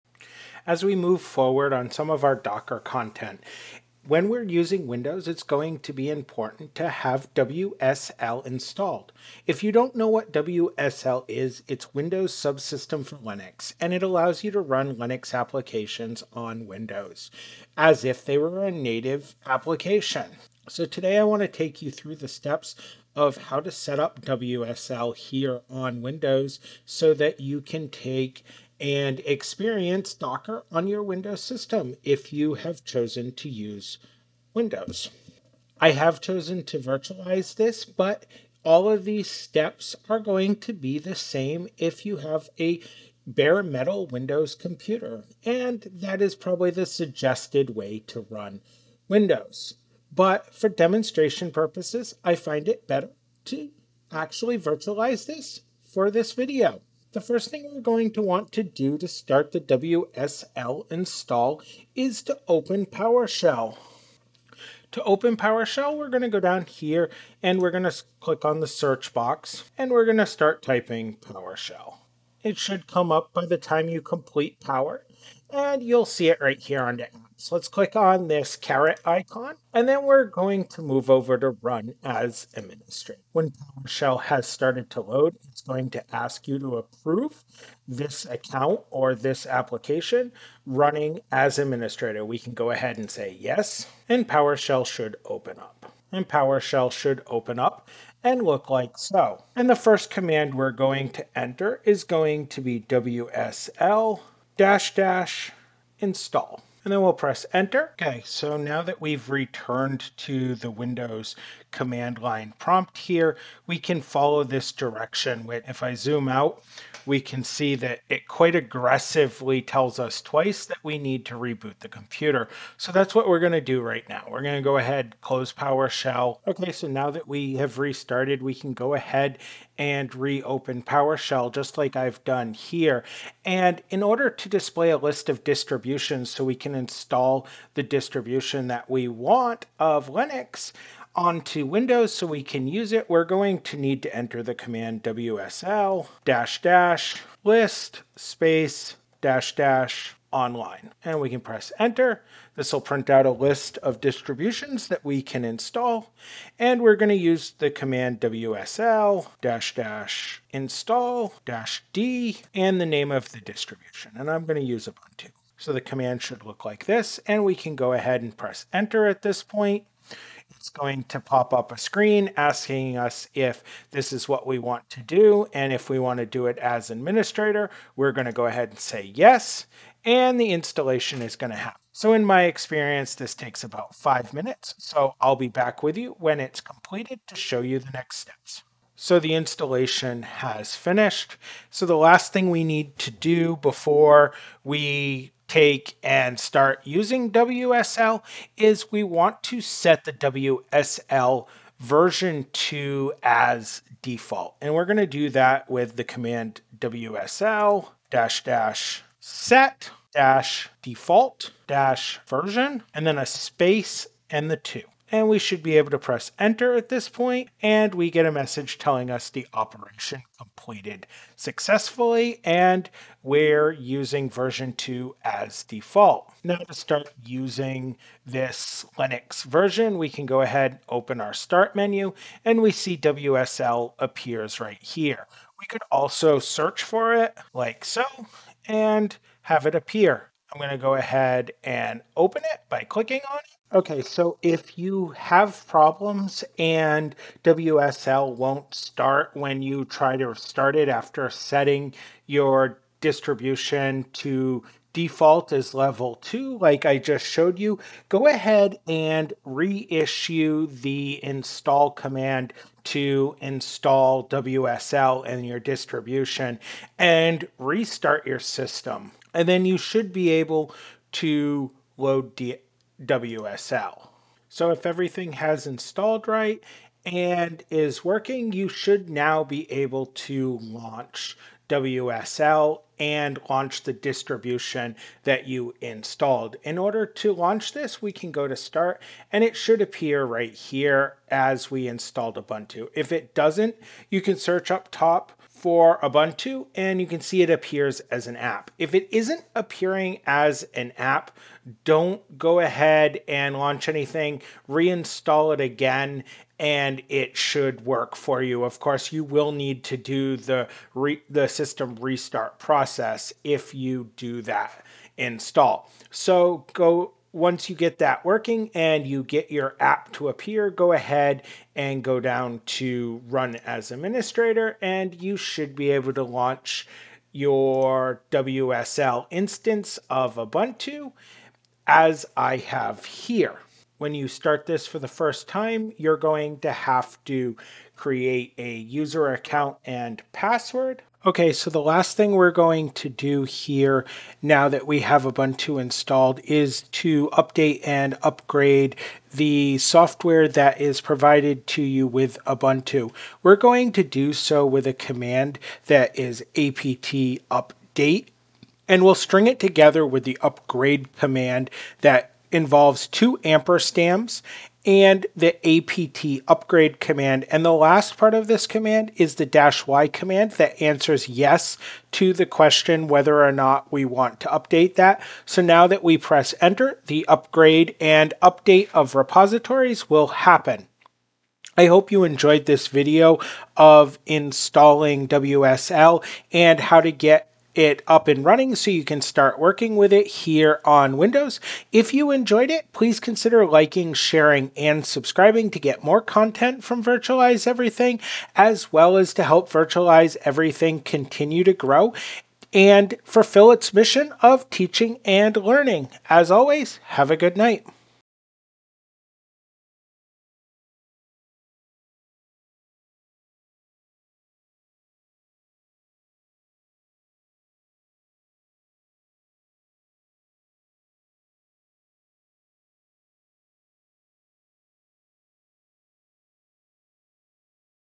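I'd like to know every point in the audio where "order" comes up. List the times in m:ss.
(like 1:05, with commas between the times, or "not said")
2:14, 4:46.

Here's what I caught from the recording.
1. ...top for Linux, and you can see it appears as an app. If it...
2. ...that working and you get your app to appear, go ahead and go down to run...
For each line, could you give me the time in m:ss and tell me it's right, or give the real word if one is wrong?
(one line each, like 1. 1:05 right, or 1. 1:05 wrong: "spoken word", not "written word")
1. 4:54 wrong: "Ubuntu", not "Linux"
2. 5:17 right.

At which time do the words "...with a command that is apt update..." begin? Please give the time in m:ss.
5:54.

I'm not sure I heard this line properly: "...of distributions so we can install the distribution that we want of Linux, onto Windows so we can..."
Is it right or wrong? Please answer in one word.
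right.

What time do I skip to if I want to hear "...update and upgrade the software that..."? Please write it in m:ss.
5:47.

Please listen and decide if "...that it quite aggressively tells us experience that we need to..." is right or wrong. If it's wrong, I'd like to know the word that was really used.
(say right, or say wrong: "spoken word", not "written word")
wrong: "twice", not "experience".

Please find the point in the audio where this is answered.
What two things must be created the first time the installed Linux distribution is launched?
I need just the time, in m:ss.
5:38.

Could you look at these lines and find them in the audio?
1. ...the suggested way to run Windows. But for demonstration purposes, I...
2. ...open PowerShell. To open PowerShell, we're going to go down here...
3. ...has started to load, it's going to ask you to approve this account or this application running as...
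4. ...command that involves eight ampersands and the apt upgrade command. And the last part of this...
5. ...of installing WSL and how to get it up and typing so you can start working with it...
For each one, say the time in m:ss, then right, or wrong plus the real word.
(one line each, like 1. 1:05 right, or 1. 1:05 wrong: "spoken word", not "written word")
1. 0:46 right
2. 1:02 right
3. 1:24 right
4. 6:01 wrong: "two", not "eight"
5. 6:23 wrong: "running", not "typing".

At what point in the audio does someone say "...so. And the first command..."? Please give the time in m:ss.
1:38.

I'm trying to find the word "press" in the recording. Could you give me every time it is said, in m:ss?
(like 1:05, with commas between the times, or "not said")
1:47, 2:31, 2:48, 3:35, 6:16.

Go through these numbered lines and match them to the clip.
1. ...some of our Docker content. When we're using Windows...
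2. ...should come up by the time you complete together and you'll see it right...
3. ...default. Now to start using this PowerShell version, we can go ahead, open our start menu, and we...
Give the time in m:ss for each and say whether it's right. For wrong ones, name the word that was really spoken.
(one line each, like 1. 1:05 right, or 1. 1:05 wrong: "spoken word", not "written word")
1. 0:01 right
2. 1:12 wrong: "power", not "together"
3. 3:45 wrong: "Linux", not "PowerShell".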